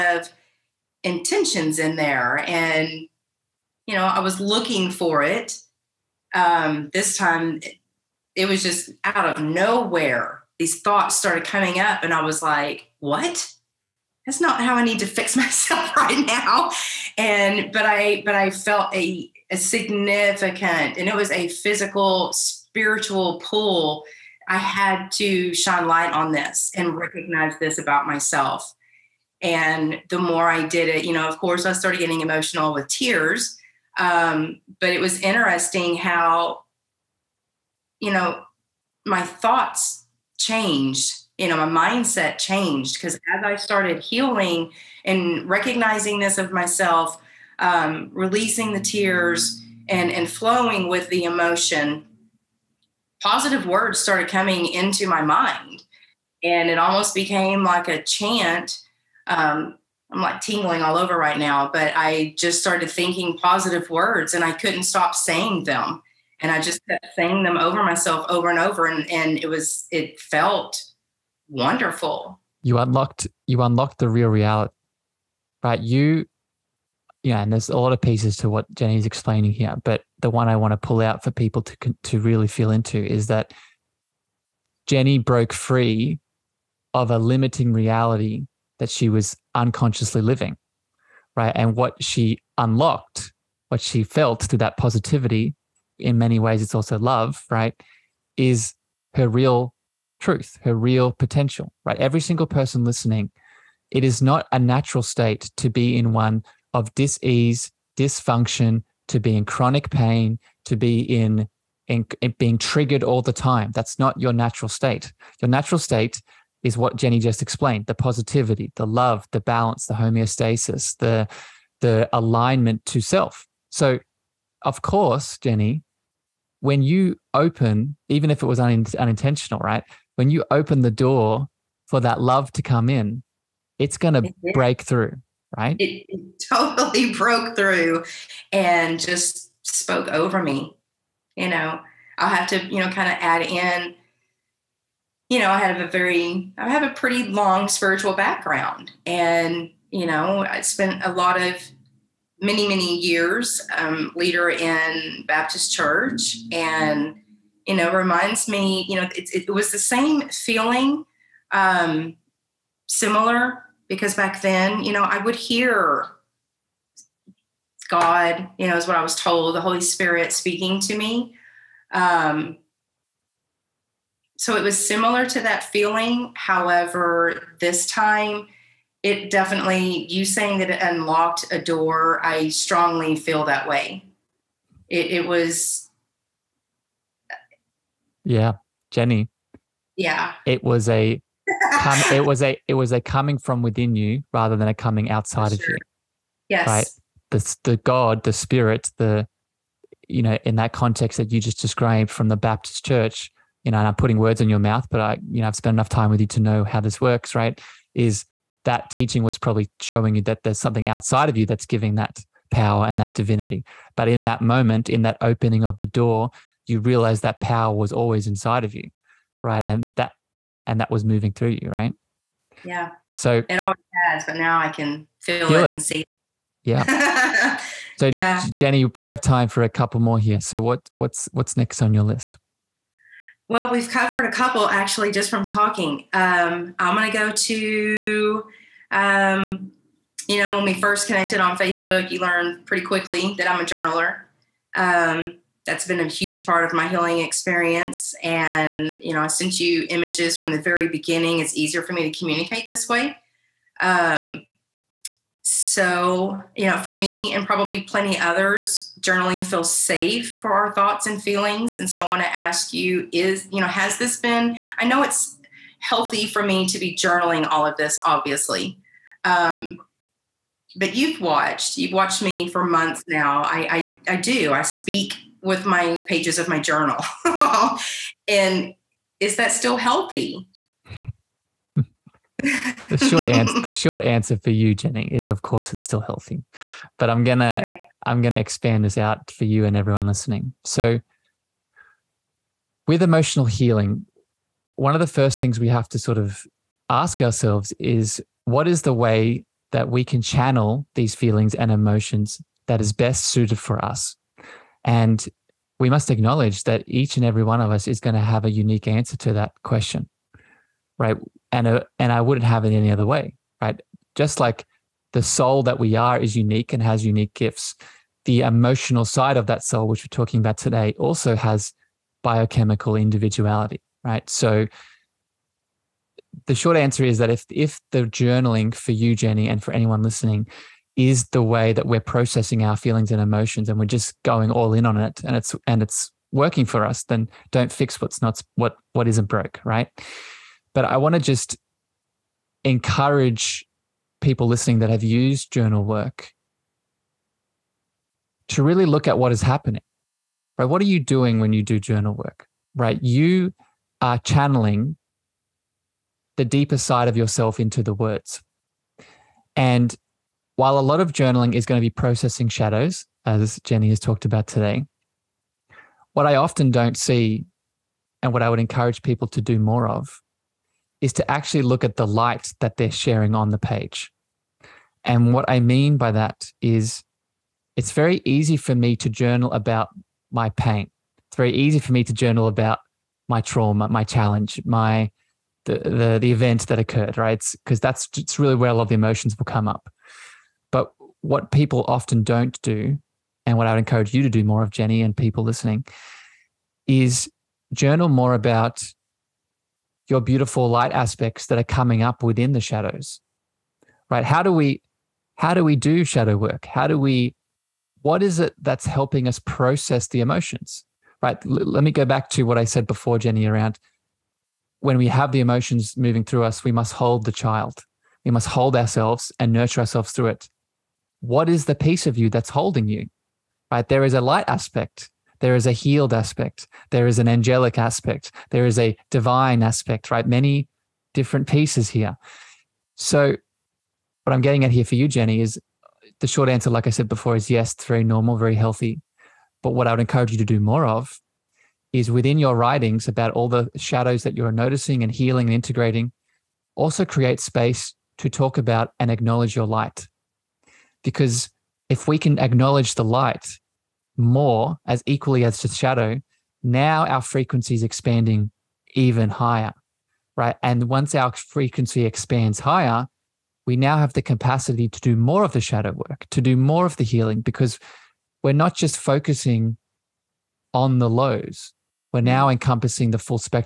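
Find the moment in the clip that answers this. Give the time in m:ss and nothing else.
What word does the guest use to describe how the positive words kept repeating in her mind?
0:58.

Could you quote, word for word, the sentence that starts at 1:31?
And what she unlocked, what she felt through that positivity in many ways it's also love, right?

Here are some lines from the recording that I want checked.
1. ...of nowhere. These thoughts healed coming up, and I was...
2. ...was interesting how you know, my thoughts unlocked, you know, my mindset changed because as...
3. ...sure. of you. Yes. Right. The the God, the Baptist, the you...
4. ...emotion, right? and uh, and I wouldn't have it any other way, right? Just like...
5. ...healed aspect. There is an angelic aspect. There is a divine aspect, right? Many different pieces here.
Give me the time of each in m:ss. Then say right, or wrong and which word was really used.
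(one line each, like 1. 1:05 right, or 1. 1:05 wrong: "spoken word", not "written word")
1. 0:09 wrong: "started", not "healed"
2. 0:35 wrong: "changed", not "unlocked"
3. 3:15 wrong: "Spirit", not "Baptist"
4. 5:09 wrong: "question", not "emotion"
5. 7:05 right.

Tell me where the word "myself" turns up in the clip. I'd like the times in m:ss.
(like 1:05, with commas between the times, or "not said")
0:15, 0:28, 0:46, 1:07.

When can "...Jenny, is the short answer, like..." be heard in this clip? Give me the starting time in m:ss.
7:15.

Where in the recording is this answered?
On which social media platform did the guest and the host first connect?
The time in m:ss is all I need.
4:01.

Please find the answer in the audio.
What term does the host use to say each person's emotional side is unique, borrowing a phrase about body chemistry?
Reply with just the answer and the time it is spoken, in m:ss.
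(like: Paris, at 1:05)
biochemical individuality, at 5:22.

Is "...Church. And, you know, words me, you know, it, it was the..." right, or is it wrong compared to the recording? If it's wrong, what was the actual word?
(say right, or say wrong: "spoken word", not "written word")
wrong: "reminds", not "words".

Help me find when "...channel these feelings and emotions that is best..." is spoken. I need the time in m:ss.
5:00.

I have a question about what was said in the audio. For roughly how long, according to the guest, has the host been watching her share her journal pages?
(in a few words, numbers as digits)
months.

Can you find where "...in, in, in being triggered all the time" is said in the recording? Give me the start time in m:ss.
1:51.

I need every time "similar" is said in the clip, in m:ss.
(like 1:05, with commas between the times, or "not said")
2:42, 2:54.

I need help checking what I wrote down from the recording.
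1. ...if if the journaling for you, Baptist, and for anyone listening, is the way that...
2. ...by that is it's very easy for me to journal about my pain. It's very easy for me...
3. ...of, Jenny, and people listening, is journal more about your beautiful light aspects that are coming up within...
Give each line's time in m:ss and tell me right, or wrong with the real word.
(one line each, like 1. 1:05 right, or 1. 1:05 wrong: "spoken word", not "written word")
1. 5:27 wrong: "Jenny", not "Baptist"
2. 6:15 right
3. 6:34 right.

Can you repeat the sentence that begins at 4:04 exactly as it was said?
Um, that's been a huge part of my healing experience.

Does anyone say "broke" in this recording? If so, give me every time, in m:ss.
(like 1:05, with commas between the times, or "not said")
1:25, 2:17, 5:39.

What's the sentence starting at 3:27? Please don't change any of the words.
Is that teaching was probably showing you that there's something outside of you that's giving that power and that divinity.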